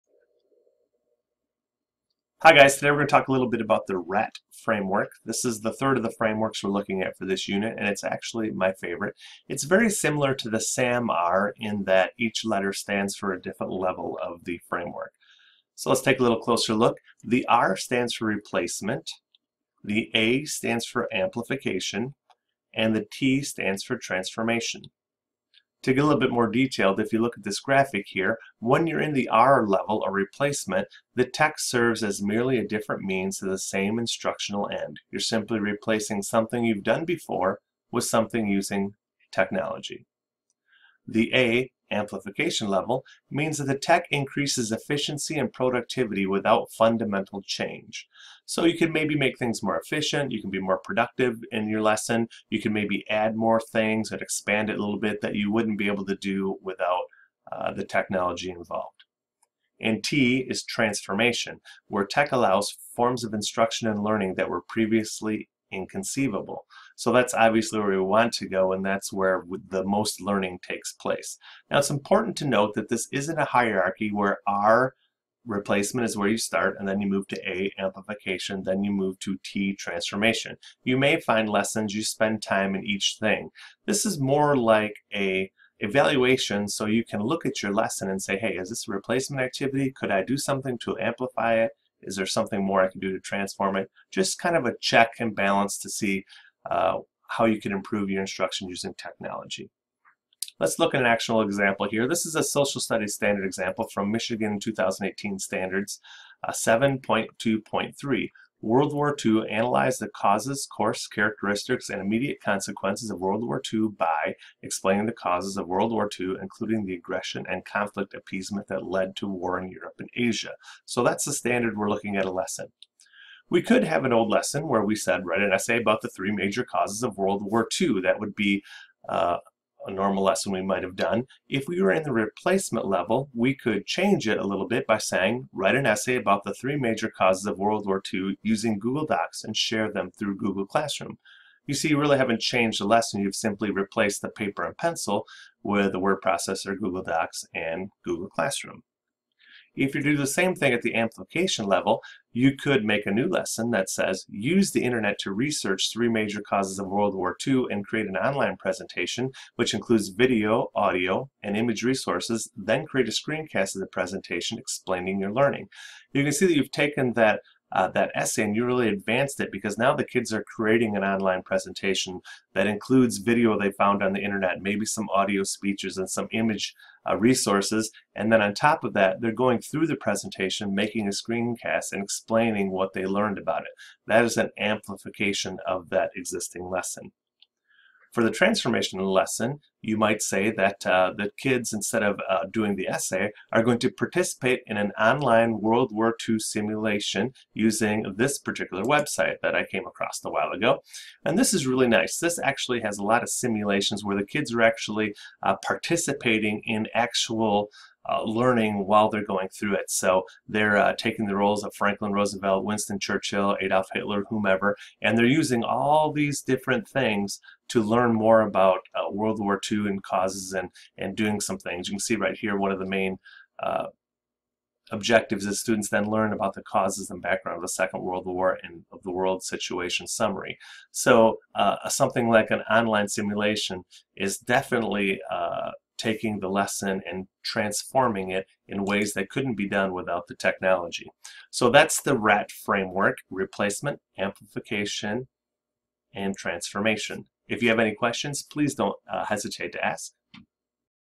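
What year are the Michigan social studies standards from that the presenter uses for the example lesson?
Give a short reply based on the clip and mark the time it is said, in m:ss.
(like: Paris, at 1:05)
2018, at 1:44.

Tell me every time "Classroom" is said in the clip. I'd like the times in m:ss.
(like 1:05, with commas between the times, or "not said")
2:20, 2:28.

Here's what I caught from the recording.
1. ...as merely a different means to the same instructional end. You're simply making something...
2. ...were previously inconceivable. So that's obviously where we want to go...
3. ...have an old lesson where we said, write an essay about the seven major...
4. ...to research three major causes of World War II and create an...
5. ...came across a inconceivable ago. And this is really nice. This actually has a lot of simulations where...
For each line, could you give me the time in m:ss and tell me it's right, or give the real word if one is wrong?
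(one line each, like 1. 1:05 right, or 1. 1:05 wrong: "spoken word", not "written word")
1. 0:32 wrong: "replacing", not "making"
2. 1:04 right
3. 2:03 wrong: "three", not "seven"
4. 2:35 right
5. 3:19 wrong: "while", not "inconceivable".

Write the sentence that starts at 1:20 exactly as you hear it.
You may find lessons you spend time in each thing.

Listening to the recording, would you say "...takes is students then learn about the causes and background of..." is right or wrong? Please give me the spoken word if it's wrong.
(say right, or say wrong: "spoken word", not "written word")
wrong: "objectives", not "takes".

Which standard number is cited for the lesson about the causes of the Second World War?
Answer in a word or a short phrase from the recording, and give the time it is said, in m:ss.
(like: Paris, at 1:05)
7.2.3, at 1:46.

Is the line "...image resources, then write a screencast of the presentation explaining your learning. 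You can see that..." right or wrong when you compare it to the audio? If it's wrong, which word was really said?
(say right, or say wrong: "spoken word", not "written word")
wrong: "create", not "write".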